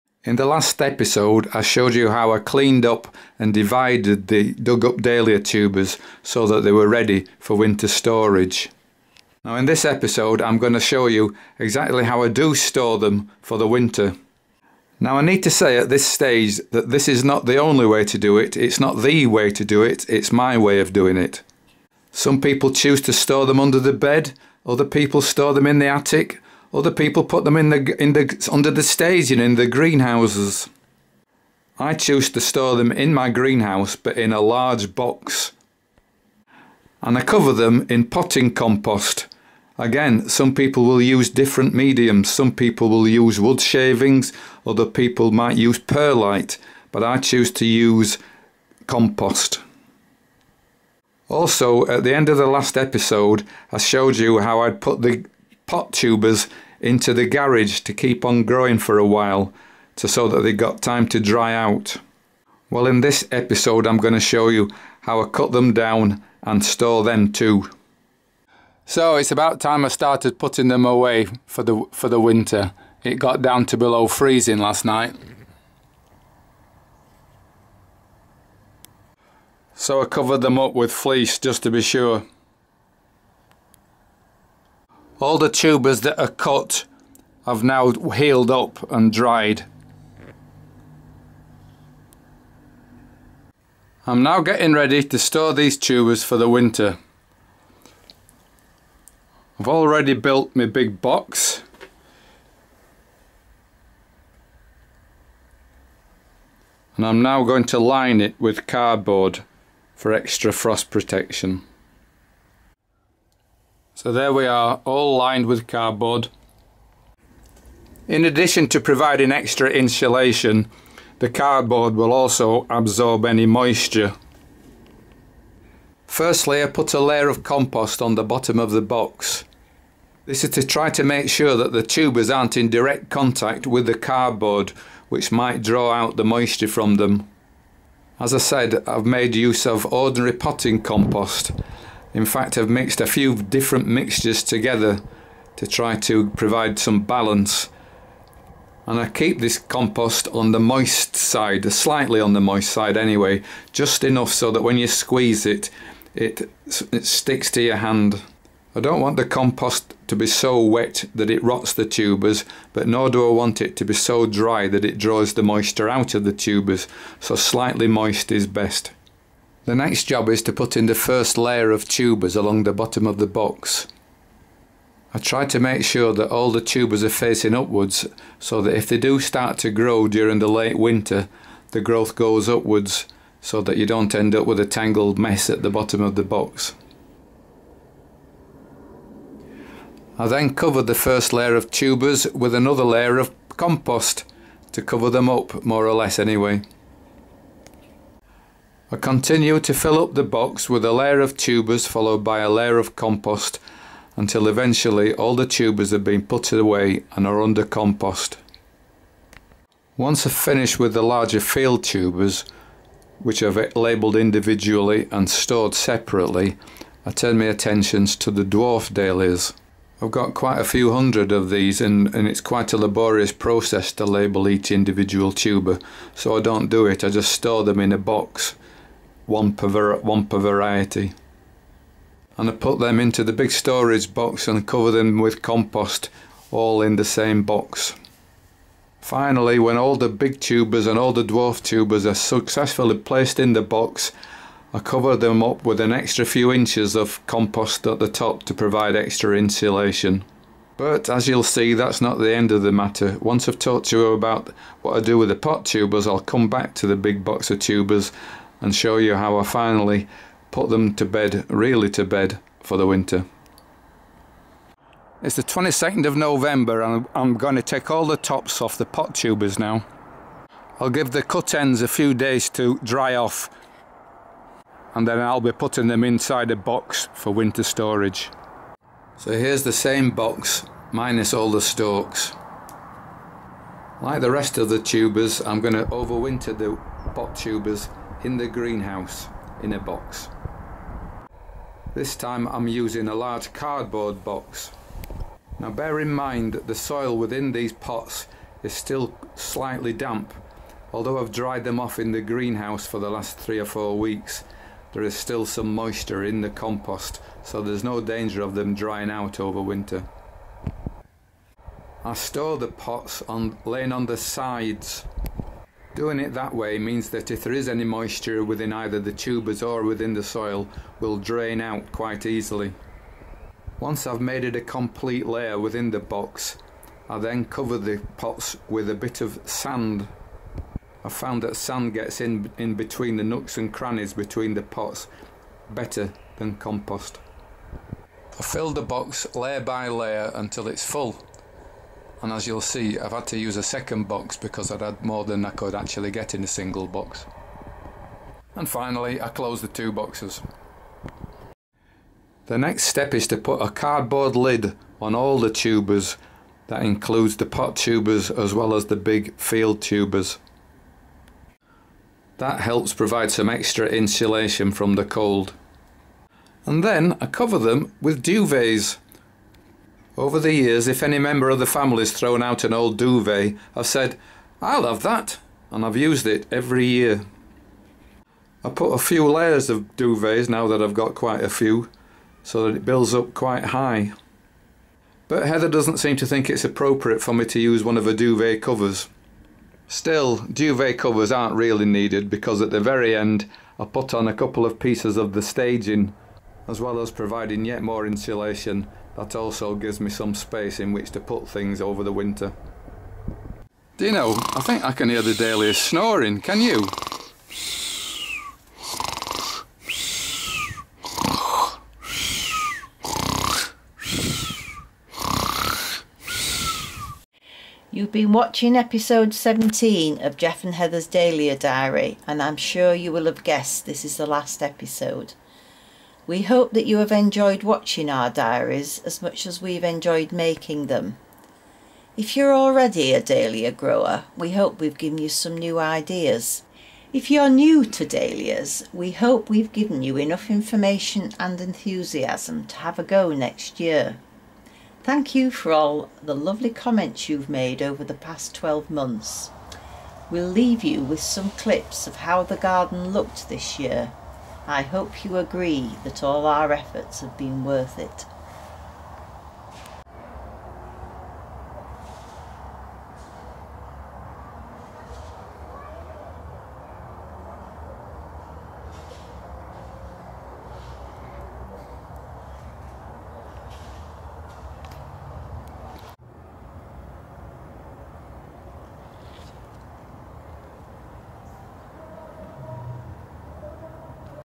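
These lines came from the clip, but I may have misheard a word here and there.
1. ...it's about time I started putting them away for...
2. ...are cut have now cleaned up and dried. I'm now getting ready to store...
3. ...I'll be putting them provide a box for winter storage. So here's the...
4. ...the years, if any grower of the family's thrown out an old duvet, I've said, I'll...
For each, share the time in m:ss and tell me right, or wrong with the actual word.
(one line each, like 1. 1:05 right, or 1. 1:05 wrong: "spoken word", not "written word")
1. 1:09 right
2. 1:26 wrong: "healed", not "cleaned"
3. 4:35 wrong: "inside", not "provide"
4. 6:10 wrong: "member", not "grower".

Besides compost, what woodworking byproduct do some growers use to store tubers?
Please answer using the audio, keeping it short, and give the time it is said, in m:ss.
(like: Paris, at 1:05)
wood shavings, at 0:43.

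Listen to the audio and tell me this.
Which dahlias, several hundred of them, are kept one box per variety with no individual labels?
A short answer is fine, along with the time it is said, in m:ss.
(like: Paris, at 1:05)
dwarf dahlias, at 3:38.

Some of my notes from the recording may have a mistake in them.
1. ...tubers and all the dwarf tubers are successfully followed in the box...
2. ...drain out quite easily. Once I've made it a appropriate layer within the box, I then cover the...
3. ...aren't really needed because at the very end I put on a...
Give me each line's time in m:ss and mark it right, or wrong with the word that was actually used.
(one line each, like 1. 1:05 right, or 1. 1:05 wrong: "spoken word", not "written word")
1. 4:00 wrong: "placed", not "followed"
2. 5:21 wrong: "complete", not "appropriate"
3. 6:31 right.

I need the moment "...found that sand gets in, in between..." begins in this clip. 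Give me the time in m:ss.
5:31.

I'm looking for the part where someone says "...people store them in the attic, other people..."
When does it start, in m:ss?
0:24.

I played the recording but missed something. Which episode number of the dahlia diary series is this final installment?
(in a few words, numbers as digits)
17.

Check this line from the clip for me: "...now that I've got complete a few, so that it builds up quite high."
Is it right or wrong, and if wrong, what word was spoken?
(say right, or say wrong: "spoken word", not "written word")
wrong: "quite", not "complete".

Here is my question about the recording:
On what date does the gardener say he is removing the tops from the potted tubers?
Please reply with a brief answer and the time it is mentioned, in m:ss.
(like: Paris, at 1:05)
22nd of November, at 4:25.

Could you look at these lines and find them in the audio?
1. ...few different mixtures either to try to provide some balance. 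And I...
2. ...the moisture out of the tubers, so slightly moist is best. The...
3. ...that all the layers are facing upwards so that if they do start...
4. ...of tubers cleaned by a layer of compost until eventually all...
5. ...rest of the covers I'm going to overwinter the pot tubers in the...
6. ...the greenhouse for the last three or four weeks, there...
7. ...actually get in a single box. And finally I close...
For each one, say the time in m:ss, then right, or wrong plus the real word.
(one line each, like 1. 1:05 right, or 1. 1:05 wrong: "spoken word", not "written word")
1. 2:23 wrong: "together", not "either"
2. 2:45 right
3. 2:56 wrong: "tubers", not "layers"
4. 3:21 wrong: "followed", not "cleaned"
5. 4:44 wrong: "tubers", not "covers"
6. 5:02 right
7. 5:45 right.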